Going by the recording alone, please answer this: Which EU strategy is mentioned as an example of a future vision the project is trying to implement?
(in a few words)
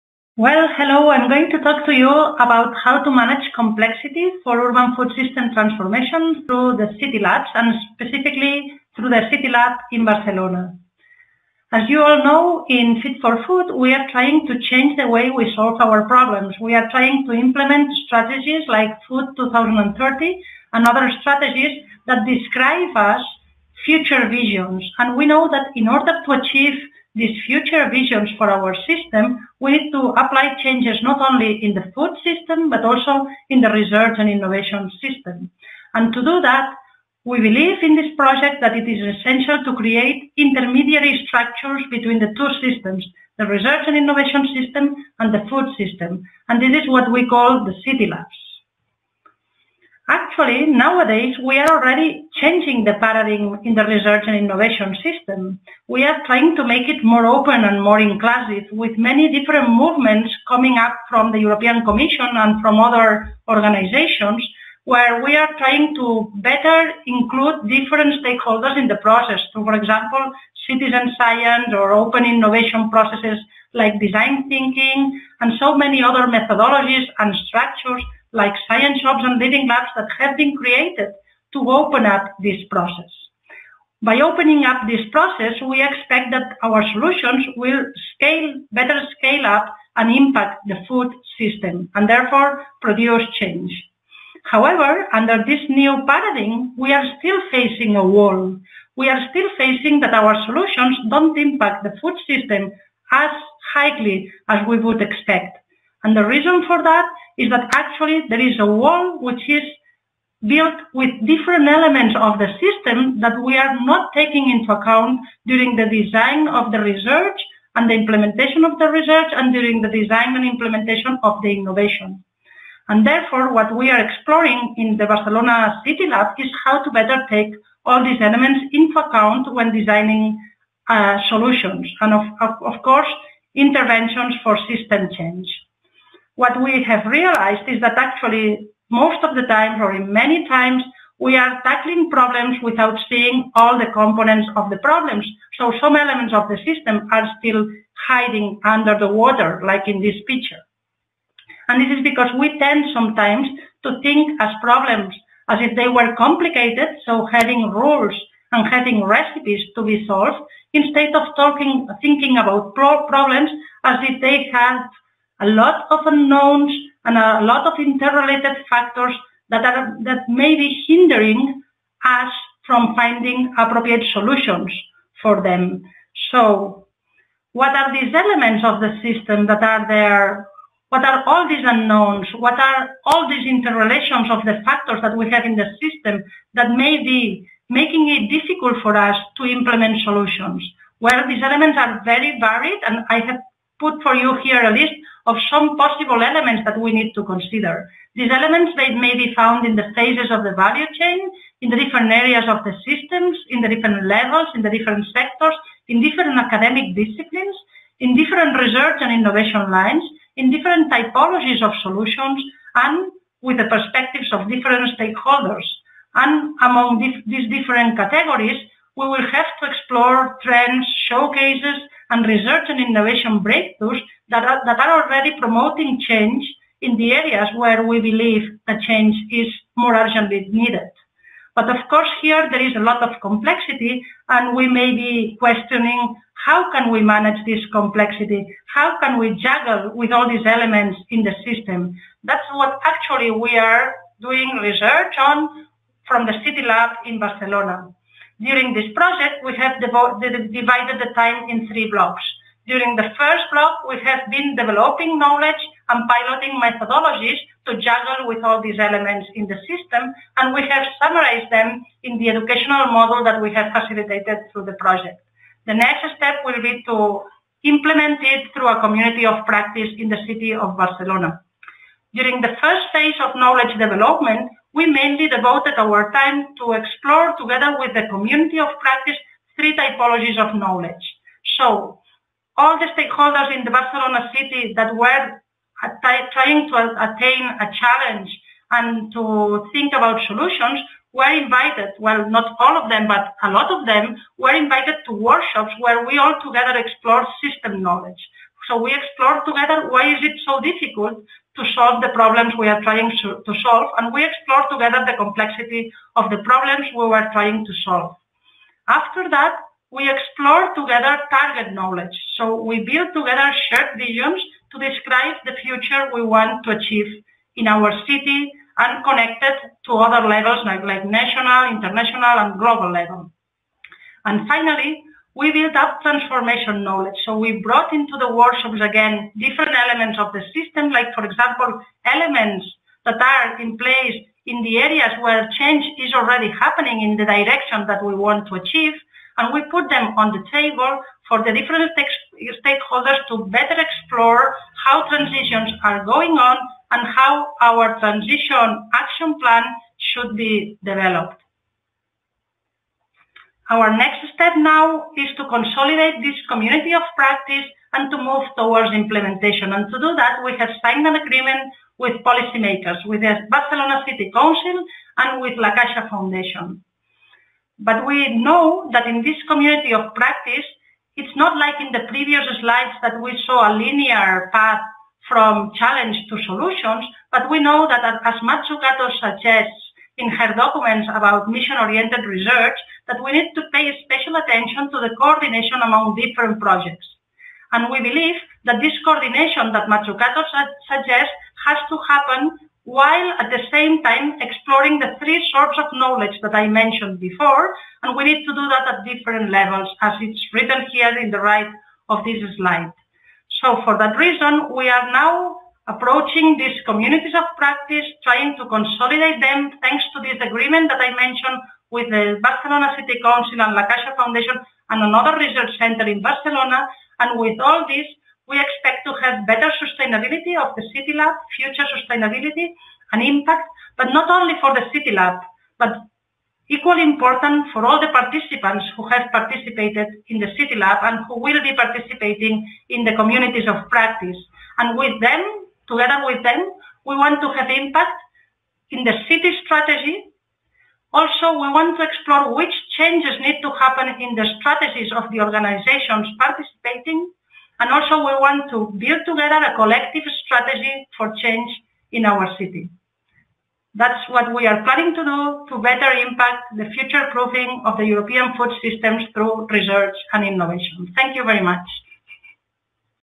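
Food 2030.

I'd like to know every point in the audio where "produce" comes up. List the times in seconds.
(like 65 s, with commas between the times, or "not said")
92 s.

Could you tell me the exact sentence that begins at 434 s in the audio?
And with them, together with them, we want to have impact in the city strategy.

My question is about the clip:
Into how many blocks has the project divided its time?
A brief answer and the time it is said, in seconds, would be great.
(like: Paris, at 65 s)
3, at 251 s.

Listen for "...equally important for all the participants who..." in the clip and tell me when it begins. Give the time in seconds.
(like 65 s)
426 s.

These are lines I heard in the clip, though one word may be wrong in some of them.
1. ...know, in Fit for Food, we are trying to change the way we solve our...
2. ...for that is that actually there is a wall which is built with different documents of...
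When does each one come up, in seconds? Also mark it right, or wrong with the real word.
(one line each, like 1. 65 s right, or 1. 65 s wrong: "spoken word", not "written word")
1. 12 s right
2. 106 s wrong: "elements", not "documents".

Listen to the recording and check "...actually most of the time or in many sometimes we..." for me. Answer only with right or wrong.
wrong.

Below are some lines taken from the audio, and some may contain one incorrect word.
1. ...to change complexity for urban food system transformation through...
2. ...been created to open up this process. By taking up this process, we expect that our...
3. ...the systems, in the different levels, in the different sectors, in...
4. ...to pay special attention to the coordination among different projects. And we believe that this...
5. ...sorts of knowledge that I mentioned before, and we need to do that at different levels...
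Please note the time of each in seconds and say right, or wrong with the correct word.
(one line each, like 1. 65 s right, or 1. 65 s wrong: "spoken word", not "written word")
1. 3 s wrong: "manage", not "change"
2. 80 s wrong: "opening", not "taking"
3. 202 s right
4. 383 s right
5. 395 s right.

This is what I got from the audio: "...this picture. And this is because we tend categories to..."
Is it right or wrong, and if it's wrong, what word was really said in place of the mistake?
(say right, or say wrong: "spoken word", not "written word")
wrong: "sometimes", not "categories".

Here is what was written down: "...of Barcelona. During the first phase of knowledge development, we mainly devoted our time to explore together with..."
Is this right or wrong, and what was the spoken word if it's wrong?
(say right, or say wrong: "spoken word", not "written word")
right.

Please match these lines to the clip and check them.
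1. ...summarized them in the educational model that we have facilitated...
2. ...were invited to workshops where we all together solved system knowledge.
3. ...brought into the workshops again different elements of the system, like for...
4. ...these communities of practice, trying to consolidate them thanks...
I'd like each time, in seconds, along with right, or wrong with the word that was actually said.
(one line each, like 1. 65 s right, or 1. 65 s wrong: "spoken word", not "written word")
1. 260 s right
2. 294 s wrong: "explored", not "solved"
3. 327 s right
4. 406 s right.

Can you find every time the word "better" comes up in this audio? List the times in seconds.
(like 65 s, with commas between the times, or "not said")
66 s, 88 s, 126 s, 343 s, 419 s, 455 s.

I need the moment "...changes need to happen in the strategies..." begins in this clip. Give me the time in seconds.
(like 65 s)
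442 s.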